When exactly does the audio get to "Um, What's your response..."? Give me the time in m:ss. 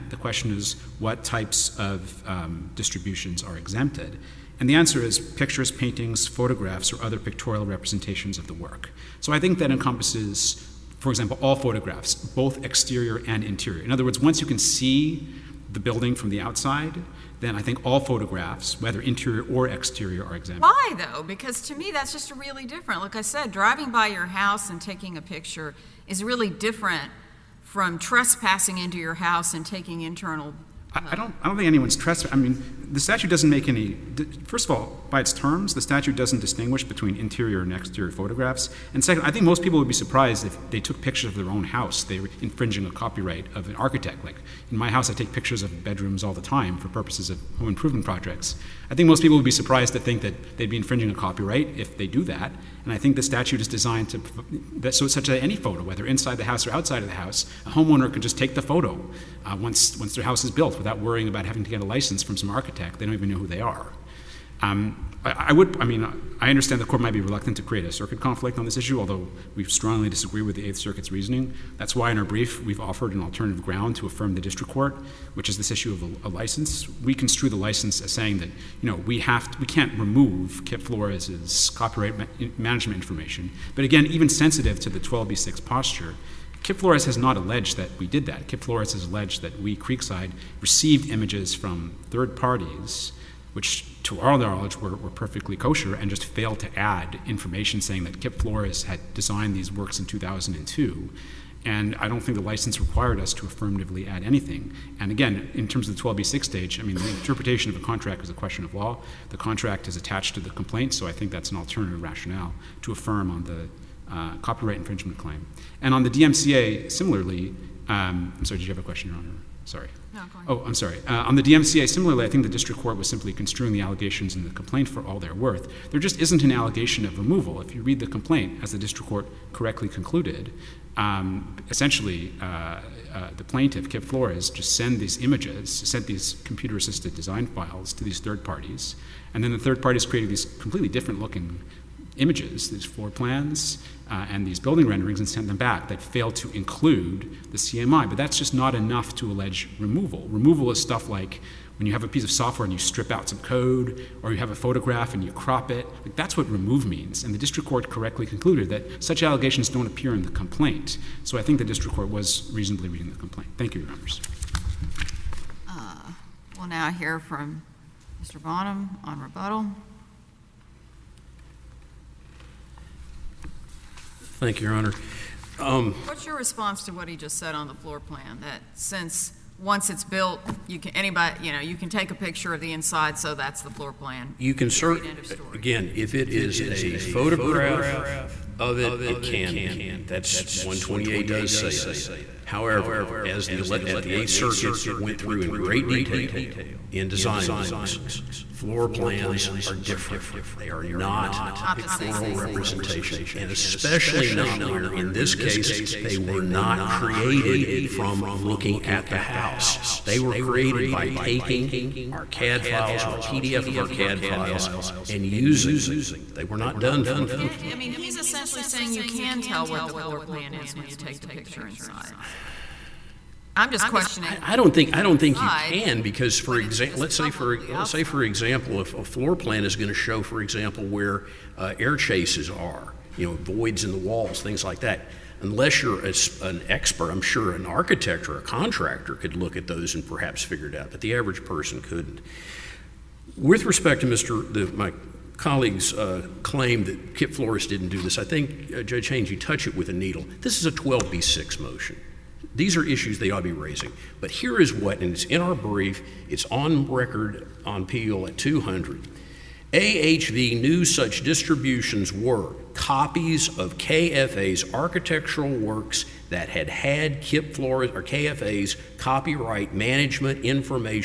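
2:55.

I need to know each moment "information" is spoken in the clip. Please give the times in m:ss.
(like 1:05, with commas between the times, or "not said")
1:22, 1:37, 4:30.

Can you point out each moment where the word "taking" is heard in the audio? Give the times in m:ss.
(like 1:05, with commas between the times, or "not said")
0:24, 0:29, 3:31.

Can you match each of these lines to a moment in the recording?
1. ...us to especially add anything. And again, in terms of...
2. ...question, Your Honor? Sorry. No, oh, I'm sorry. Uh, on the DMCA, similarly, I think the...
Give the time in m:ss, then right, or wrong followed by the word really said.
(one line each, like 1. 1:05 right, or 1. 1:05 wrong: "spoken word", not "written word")
1. 1:43 wrong: "affirmatively", not "especially"
2. 1:58 right.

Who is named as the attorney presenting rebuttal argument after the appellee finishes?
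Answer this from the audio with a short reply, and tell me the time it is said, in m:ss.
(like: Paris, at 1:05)
Mr. Bonham, at 2:48.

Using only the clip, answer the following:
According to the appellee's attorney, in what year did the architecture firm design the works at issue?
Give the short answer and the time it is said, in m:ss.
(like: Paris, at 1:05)
2002, at 1:40.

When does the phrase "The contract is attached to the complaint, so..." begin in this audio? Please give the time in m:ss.
1:49.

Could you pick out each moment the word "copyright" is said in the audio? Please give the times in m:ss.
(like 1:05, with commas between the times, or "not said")
0:42, 0:51, 1:21, 1:54, 4:28.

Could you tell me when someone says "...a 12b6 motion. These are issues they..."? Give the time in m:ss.
4:10.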